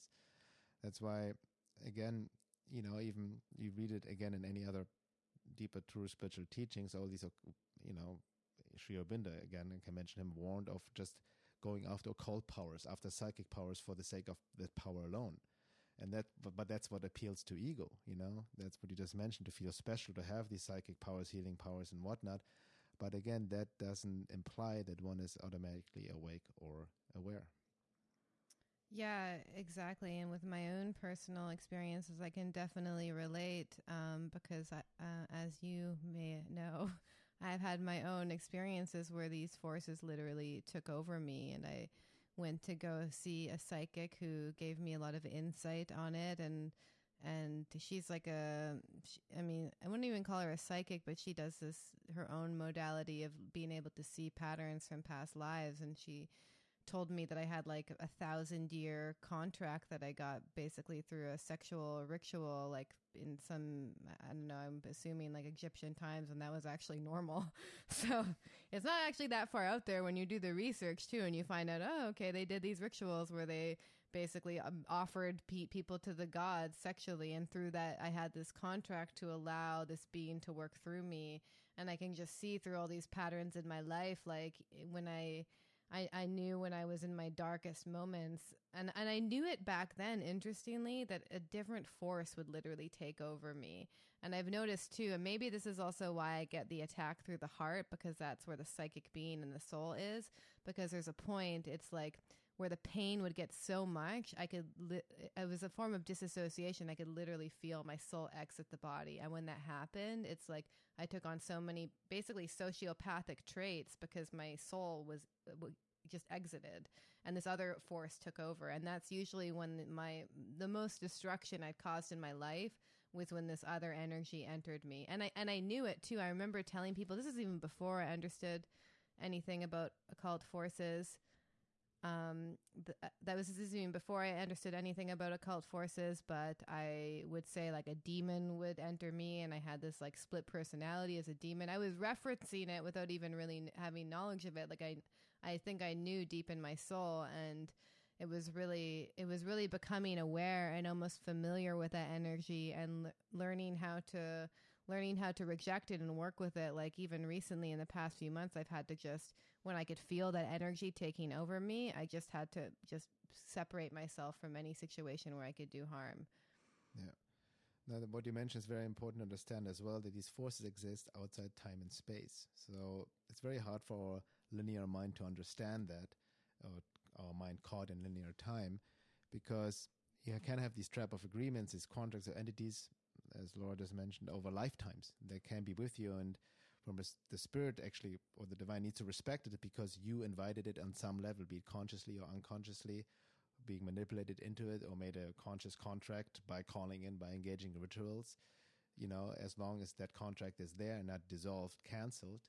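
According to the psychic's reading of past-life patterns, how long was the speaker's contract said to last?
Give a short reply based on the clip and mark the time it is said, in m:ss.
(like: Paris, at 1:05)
1000 years, at 0:57.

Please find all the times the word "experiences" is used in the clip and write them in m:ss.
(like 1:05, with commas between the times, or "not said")
0:31, 0:38.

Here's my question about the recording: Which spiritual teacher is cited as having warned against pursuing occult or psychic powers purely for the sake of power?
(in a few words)
Sri Aurobindo.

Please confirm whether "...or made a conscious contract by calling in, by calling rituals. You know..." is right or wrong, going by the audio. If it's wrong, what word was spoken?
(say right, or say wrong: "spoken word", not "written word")
wrong: "engaging", not "calling".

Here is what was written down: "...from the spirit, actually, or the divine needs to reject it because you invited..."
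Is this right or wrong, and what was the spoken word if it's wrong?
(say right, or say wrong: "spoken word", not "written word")
wrong: "respect", not "reject".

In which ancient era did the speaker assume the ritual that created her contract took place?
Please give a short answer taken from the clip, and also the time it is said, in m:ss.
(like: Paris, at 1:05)
Egyptian times, at 1:05.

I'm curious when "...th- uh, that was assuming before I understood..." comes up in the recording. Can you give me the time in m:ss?
2:12.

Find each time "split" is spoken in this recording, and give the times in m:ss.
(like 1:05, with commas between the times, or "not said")
2:20.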